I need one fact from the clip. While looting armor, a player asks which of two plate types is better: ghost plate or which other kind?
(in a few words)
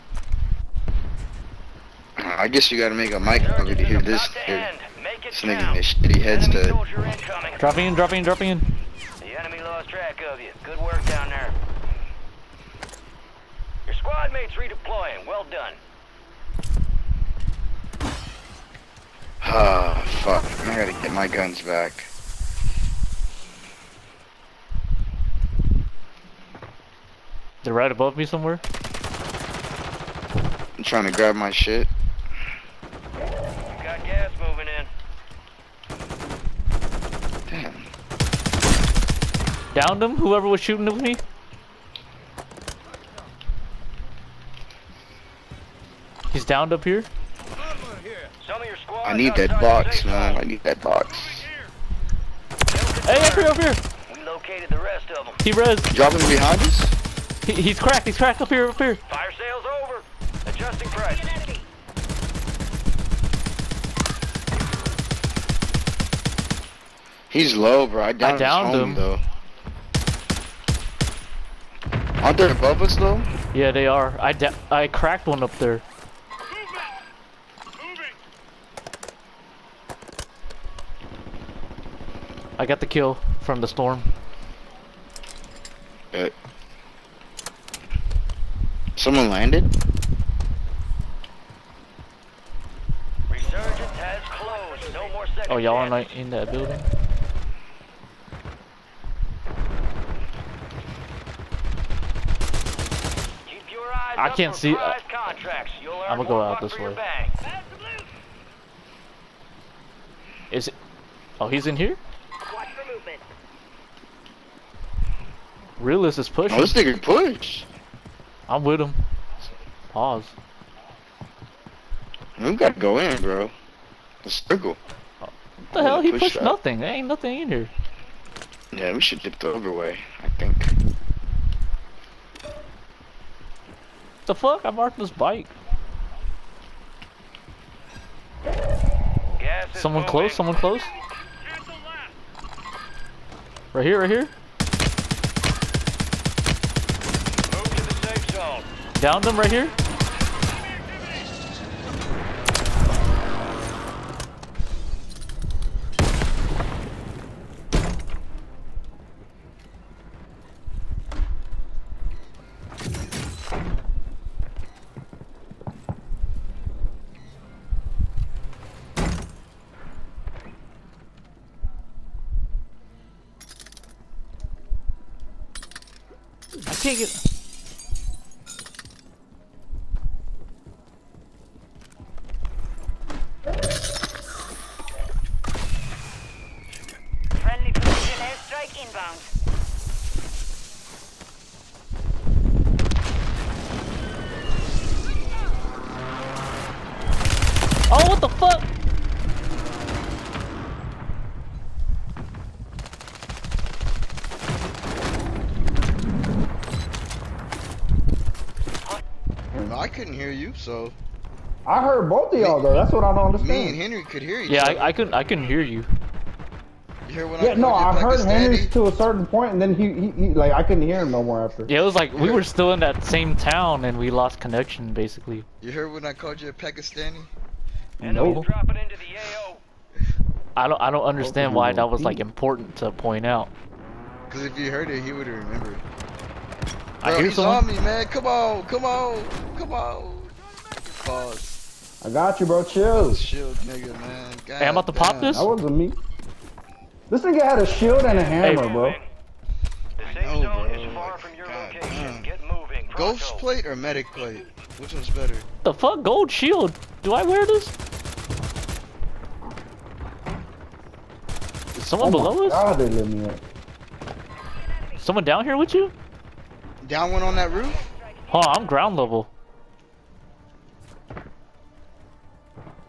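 Medic plate.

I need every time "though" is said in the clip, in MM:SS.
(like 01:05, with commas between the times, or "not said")
01:08, 01:12, 03:32.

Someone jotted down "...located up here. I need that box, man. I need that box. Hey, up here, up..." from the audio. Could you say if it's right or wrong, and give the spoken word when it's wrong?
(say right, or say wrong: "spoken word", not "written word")
wrong: "downed", not "located".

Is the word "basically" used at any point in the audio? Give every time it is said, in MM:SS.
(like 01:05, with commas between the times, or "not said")
03:44.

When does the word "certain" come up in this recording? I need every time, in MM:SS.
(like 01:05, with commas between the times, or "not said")
03:38.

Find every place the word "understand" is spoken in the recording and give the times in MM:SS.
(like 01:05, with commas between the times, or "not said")
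03:33, 03:51.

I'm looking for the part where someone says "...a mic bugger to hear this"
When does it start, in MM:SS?
00:03.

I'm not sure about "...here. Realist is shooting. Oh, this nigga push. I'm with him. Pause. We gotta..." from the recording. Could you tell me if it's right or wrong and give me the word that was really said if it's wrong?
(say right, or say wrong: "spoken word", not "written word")
wrong: "pushing", not "shooting".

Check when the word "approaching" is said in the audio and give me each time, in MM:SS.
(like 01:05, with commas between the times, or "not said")
not said.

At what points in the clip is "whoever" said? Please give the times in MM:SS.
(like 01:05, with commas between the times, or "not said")
00:40.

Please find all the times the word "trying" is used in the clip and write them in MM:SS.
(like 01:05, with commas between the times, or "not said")
00:30.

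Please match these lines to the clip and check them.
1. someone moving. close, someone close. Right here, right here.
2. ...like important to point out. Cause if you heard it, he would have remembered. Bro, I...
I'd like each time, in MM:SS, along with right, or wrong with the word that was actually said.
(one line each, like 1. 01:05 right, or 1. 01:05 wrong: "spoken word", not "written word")
1. 02:19 right
2. 03:52 right.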